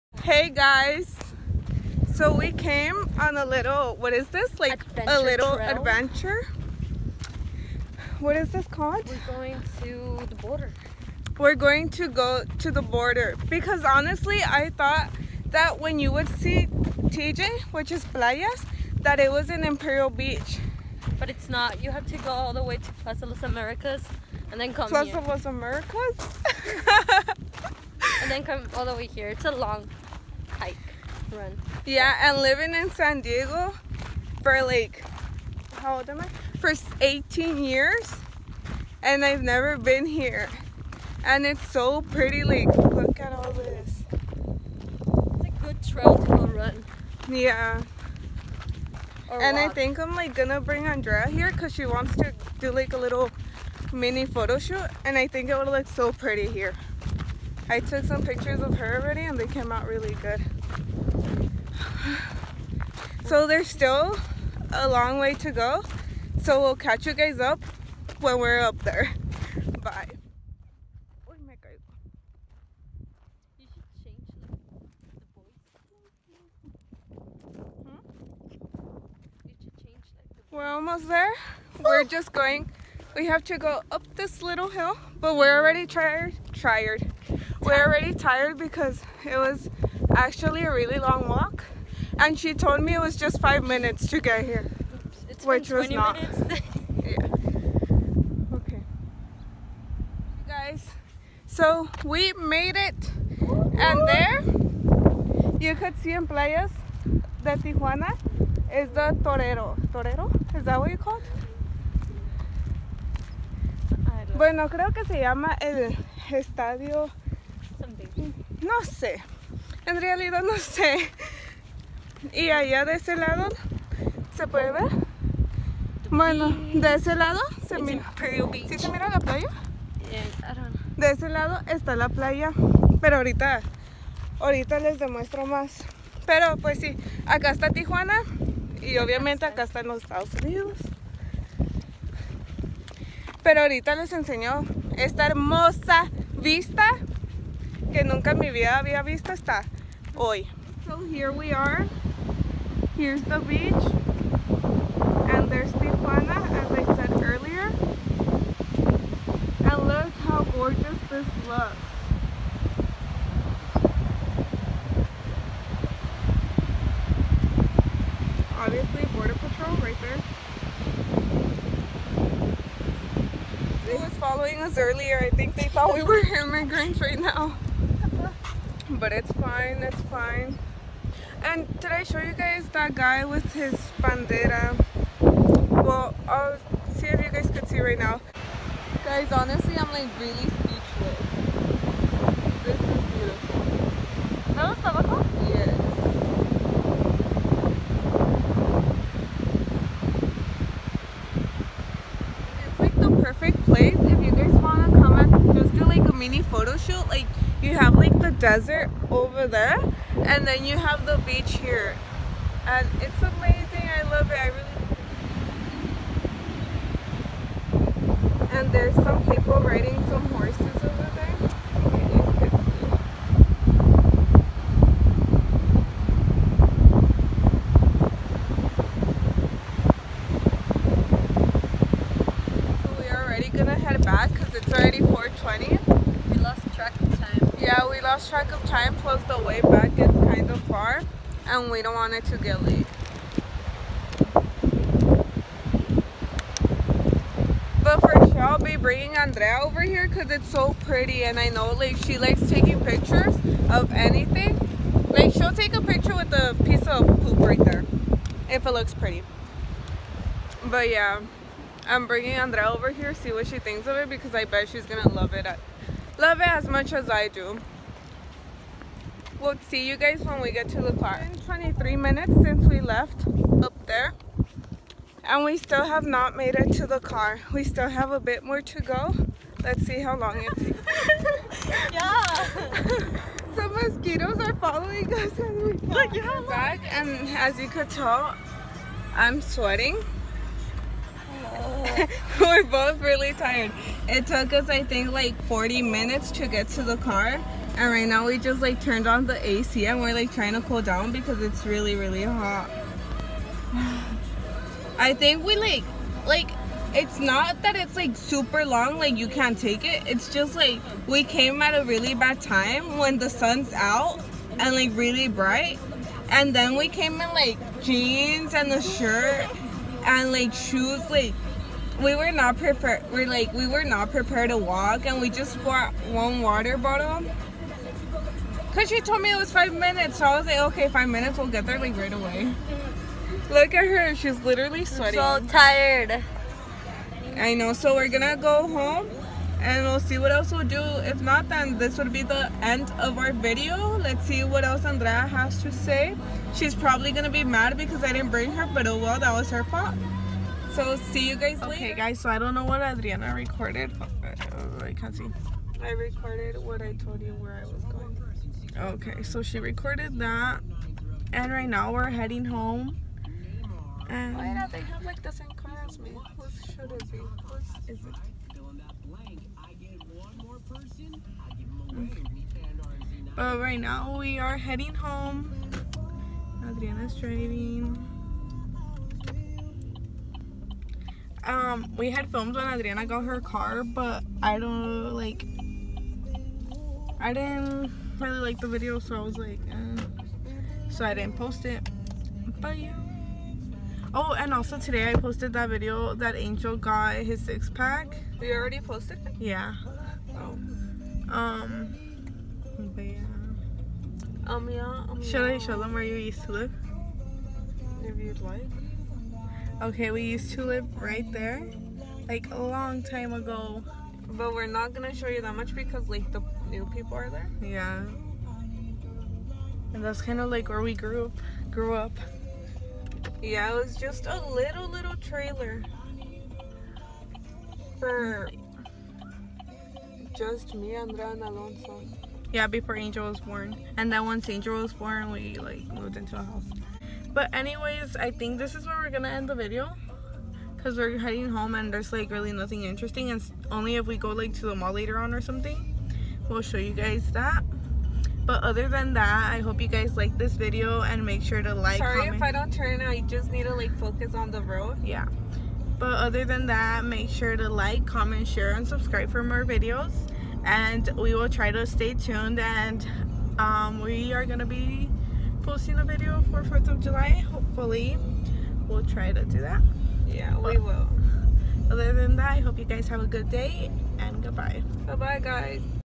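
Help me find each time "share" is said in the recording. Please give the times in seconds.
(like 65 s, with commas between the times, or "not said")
458 s.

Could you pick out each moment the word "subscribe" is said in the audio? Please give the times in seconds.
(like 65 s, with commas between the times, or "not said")
458 s.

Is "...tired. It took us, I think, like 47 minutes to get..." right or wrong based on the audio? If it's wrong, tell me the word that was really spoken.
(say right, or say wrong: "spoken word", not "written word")
wrong: "40", not "47".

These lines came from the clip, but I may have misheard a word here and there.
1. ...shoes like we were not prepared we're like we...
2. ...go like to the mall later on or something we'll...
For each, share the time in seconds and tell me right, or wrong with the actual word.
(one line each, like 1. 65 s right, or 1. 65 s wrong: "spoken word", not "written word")
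1. 320 s right
2. 444 s right.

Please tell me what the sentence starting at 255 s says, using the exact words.
Like she'll take a picture with a piece of poop right there, if it looks pretty.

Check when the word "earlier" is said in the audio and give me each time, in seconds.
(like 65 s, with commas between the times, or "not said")
157 s, 174 s.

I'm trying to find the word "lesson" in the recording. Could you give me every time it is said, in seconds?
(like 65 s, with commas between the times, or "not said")
not said.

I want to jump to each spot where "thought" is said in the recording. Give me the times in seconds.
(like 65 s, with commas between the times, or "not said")
14 s, 175 s.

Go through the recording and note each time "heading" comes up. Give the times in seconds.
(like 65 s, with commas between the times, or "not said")
362 s, 374 s, 441 s.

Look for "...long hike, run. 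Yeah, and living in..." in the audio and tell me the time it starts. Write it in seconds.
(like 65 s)
29 s.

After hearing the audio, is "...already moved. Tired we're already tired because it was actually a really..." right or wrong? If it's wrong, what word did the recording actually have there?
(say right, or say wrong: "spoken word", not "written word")
wrong: "tired", not "moved".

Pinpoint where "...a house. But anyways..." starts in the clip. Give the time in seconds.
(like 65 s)
436 s.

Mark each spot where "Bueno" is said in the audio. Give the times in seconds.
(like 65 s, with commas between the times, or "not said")
114 s, 126 s.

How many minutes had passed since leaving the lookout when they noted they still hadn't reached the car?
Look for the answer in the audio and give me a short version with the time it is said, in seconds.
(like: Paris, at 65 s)
23, at 271 s.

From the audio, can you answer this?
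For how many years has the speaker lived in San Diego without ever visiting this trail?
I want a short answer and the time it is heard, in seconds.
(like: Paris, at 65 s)
18, at 37 s.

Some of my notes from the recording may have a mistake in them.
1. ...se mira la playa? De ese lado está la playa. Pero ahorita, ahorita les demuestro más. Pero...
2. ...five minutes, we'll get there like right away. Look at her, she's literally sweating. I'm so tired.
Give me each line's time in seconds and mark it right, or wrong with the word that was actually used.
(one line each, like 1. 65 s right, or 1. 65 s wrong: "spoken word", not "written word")
1. 128 s right
2. 330 s right.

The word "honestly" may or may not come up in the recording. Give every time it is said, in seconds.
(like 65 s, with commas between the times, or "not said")
13 s, 189 s.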